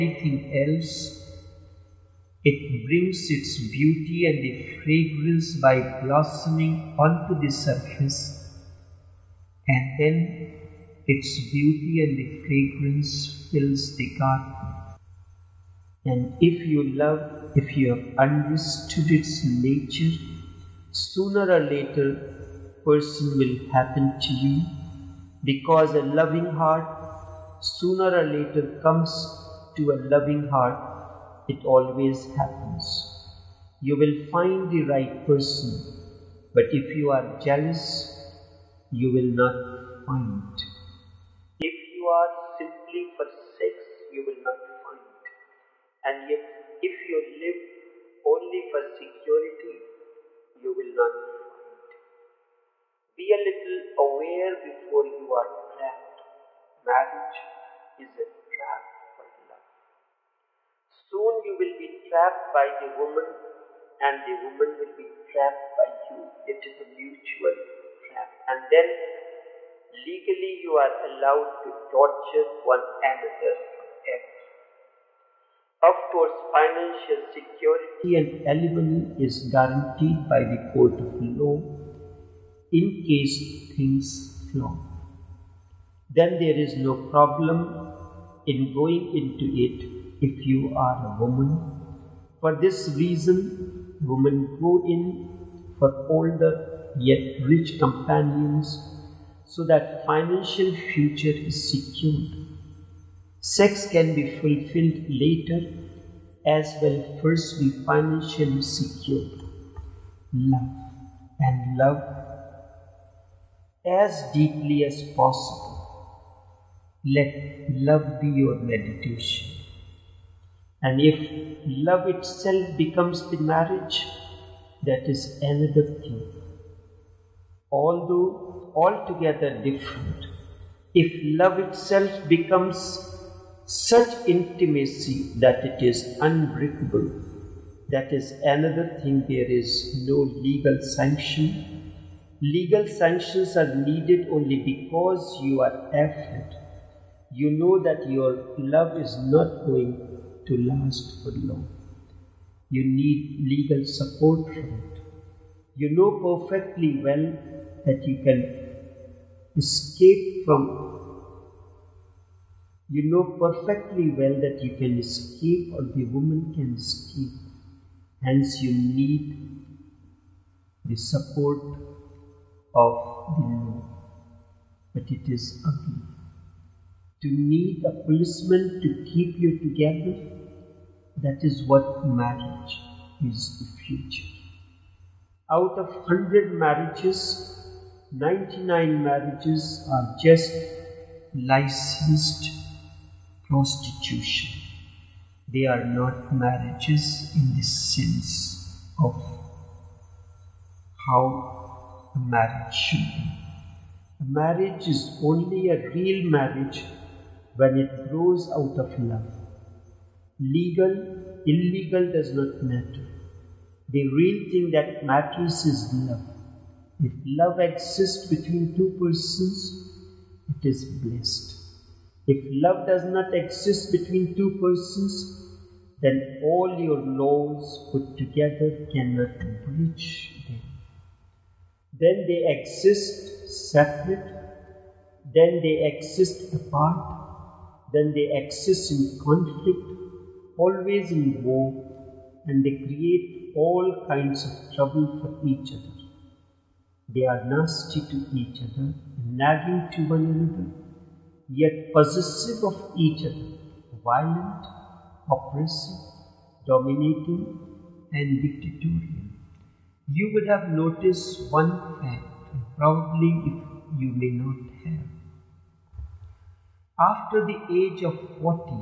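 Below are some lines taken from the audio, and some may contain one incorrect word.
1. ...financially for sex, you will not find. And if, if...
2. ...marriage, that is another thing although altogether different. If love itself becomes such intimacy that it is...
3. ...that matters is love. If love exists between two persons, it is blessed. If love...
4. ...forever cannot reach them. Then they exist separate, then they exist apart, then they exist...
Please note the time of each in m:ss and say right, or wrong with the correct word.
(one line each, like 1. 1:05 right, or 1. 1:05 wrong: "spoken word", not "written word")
1. 0:42 wrong: "simply", not "financially"
2. 2:03 right
3. 3:34 right
4. 3:48 wrong: "together", not "forever".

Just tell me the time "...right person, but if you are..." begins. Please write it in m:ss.
0:34.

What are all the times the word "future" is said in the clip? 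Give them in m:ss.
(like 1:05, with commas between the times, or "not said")
1:40, 3:03.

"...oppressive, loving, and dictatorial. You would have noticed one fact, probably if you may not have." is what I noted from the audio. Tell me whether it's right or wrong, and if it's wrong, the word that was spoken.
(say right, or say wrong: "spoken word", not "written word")
wrong: "dominating", not "loving".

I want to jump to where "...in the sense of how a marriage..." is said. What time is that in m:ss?
3:17.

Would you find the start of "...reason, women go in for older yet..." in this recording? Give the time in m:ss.
1:32.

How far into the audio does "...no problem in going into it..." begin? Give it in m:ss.
1:26.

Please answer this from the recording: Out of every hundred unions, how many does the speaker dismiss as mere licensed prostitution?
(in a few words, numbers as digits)
99.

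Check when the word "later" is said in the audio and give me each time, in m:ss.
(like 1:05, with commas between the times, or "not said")
0:21, 0:28, 1:45.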